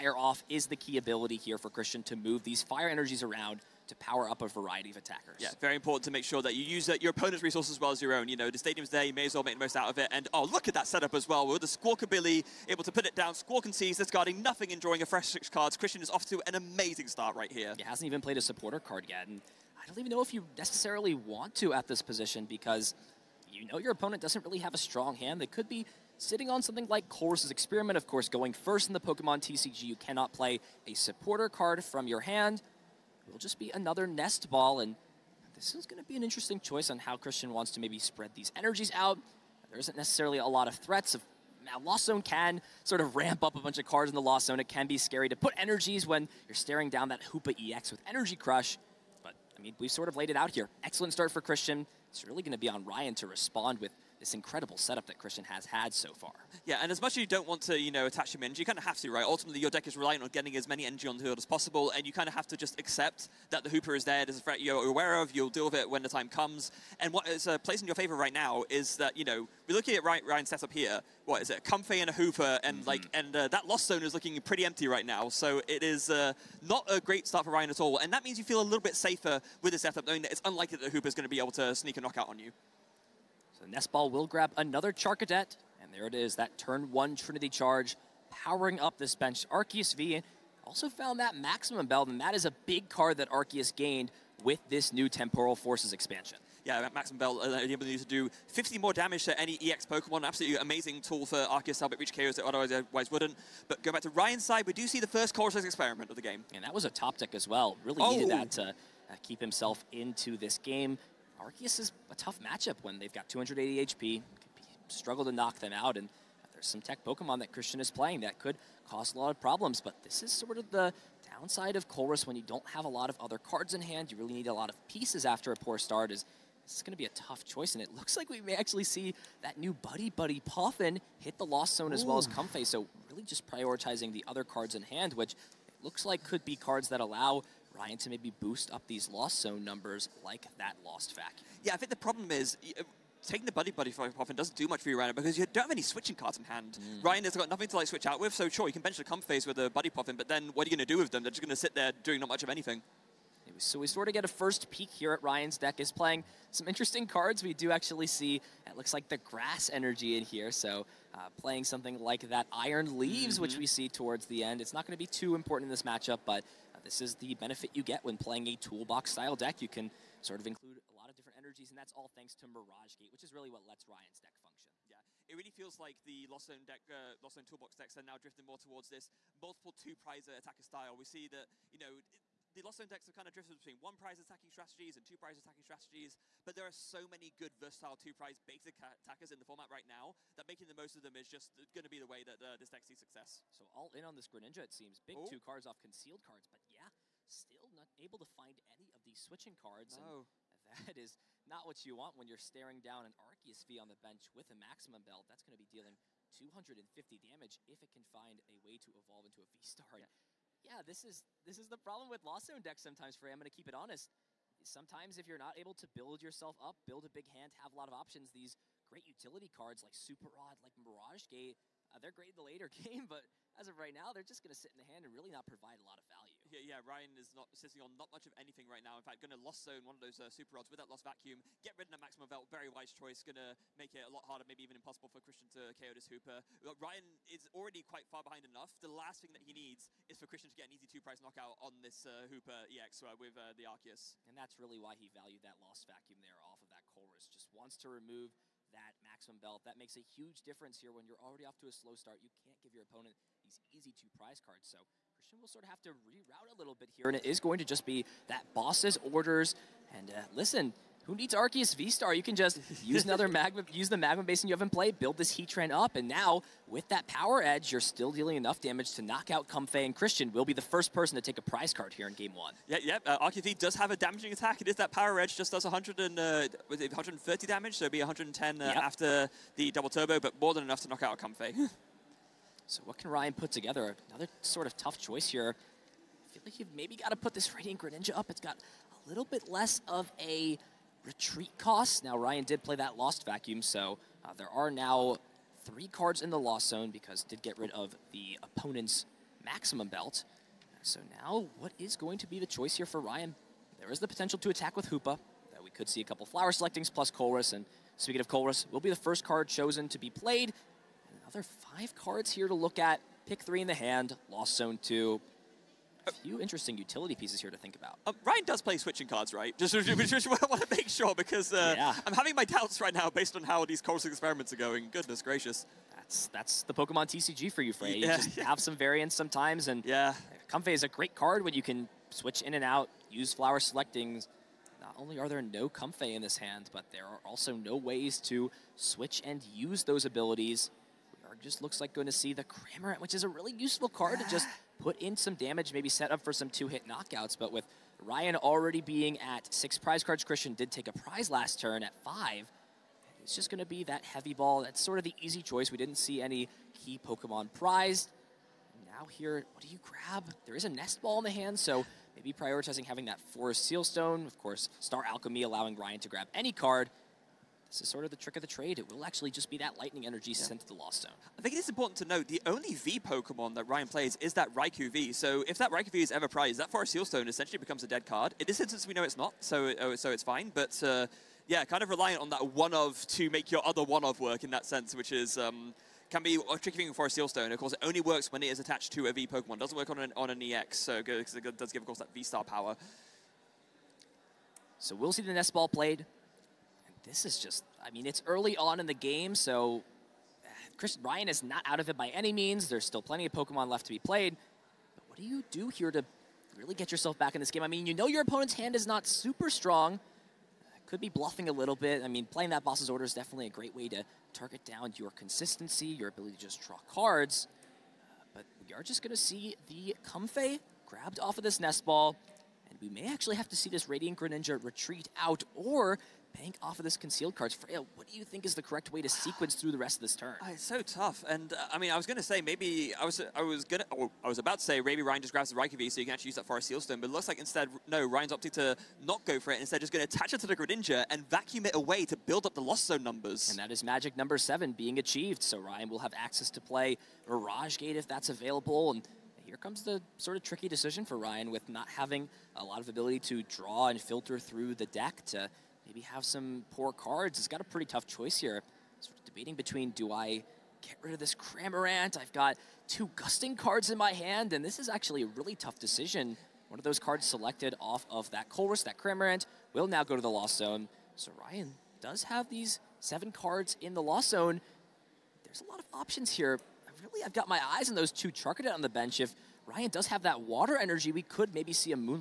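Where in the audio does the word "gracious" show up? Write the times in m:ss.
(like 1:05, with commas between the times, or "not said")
5:25.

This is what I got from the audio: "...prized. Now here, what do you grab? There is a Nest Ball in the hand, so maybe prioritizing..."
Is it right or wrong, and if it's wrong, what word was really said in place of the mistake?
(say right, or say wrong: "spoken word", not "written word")
right.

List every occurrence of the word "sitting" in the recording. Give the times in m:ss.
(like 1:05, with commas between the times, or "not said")
0:26, 3:47.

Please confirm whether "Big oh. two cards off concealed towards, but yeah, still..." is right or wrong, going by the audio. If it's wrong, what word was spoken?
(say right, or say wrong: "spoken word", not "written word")
wrong: "cards", not "towards".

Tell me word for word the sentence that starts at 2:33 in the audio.
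So we sort of get a first peek here at Ryan's deck is playing some interesting cards.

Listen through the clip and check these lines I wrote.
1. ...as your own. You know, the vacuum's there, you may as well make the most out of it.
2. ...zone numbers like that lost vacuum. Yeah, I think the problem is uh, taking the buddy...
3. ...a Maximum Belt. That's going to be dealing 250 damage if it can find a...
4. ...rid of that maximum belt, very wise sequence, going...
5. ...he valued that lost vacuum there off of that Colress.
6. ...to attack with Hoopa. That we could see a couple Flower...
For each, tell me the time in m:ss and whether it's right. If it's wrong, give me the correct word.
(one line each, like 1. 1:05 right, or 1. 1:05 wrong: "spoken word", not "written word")
1. 0:07 wrong: "stadium", not "vacuum"
2. 2:19 right
3. 3:24 right
4. 3:51 wrong: "choice", not "sequence"
5. 4:04 right
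6. 5:04 right.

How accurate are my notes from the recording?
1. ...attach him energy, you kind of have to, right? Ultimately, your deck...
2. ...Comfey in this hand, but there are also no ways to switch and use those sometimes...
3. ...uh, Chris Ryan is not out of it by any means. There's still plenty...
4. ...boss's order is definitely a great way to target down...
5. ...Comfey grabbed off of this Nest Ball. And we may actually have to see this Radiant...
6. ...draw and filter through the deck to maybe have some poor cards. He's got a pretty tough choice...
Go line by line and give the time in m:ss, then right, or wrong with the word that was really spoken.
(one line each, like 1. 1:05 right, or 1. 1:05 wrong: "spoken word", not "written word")
1. 0:58 right
2. 5:35 wrong: "abilities", not "sometimes"
3. 6:40 right
4. 6:52 right
5. 7:00 right
6. 7:33 right.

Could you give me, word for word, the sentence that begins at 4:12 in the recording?
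You can't give your opponent these easy two prize cards.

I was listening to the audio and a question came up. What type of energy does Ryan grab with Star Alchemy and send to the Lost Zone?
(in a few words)
Lightning.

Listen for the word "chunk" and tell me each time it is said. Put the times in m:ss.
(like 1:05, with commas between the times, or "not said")
not said.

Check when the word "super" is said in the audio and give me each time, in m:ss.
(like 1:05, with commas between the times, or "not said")
3:39, 3:50, 6:49.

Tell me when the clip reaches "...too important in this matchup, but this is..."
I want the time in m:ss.
2:45.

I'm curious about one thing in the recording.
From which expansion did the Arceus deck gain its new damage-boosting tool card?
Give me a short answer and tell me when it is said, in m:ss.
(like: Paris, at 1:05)
Temporal Forces, at 1:35.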